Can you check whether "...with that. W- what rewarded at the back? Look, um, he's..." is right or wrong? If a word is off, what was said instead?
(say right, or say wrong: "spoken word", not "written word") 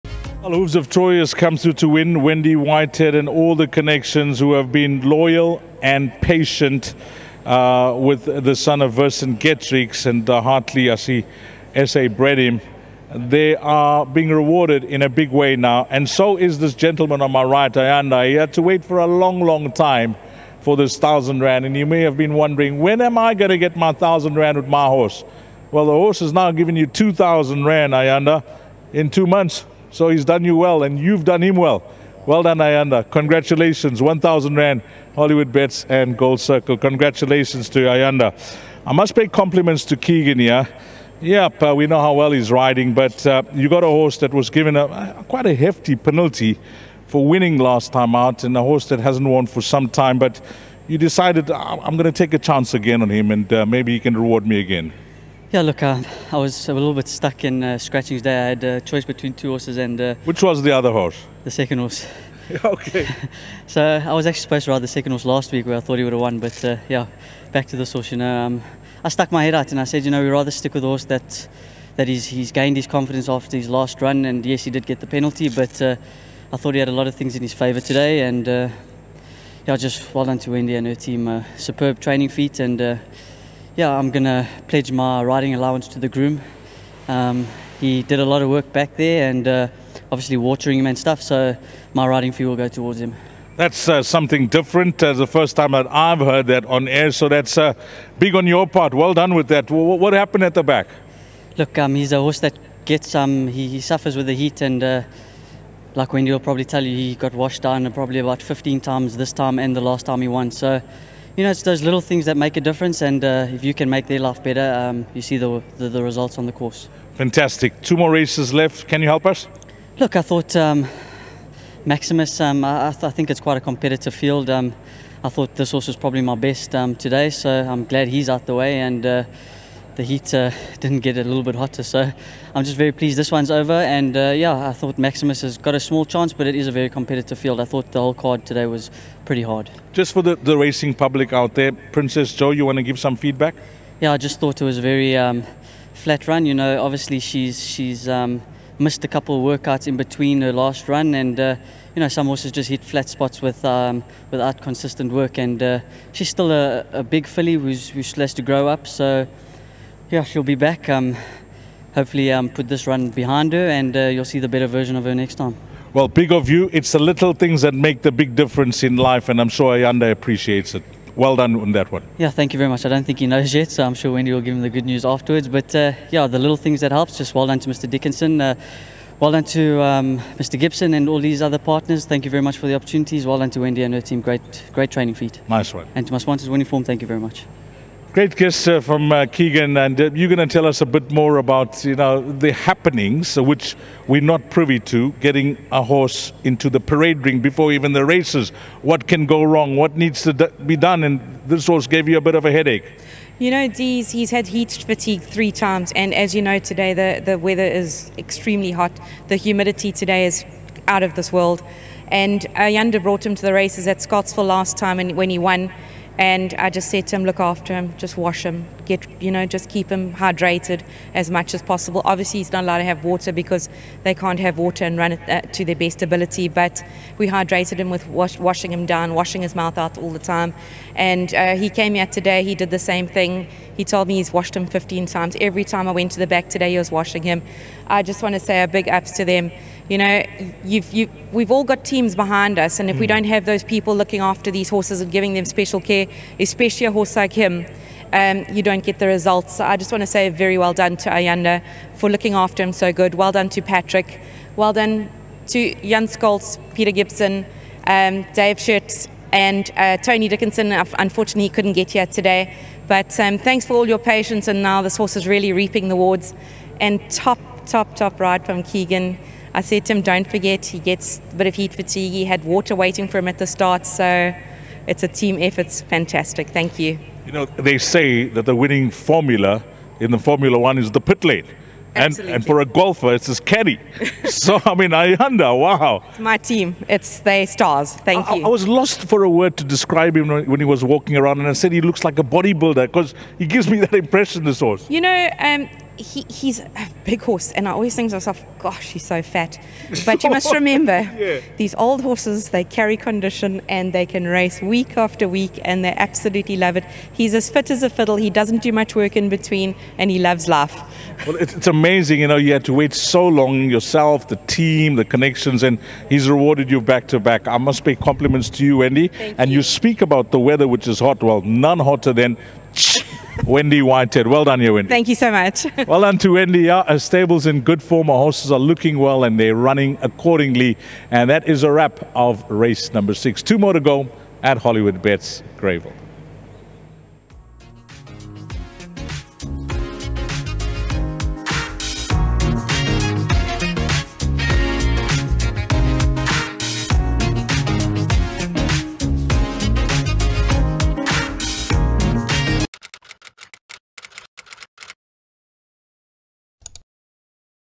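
wrong: "happened", not "rewarded".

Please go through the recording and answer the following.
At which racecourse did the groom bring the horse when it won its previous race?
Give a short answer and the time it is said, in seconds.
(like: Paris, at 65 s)
Scottsville, at 214 s.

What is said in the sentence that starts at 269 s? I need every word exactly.
I said to him, don't forget, he gets a bit of heat fatigue.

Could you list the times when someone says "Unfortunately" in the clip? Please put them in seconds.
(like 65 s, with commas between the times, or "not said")
260 s.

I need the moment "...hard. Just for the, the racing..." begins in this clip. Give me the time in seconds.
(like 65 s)
139 s.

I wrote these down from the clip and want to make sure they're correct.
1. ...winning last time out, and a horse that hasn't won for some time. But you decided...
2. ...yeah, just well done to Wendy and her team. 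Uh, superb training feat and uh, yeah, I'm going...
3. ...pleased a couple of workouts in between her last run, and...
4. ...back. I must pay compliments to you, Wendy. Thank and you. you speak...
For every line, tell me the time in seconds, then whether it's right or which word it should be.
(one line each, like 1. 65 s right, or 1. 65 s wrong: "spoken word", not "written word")
1. 47 s right
2. 79 s right
3. 148 s wrong: "missed", not "pleased"
4. 317 s right.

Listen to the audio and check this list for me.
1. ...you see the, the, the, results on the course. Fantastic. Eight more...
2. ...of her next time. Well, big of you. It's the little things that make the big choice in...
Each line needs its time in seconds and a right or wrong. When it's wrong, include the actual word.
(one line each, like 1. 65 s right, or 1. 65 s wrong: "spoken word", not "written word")
1. 115 s wrong: "Two", not "Eight"
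2. 164 s wrong: "difference", not "choice".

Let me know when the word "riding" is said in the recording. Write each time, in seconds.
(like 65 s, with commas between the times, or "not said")
42 s, 85 s, 92 s.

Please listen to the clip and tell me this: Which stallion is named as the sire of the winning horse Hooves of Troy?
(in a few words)
Vercingetorix.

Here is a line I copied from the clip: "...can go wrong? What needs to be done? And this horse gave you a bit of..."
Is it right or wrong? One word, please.
right.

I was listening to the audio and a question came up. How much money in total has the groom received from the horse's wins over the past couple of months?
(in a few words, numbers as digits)
2,000 rand.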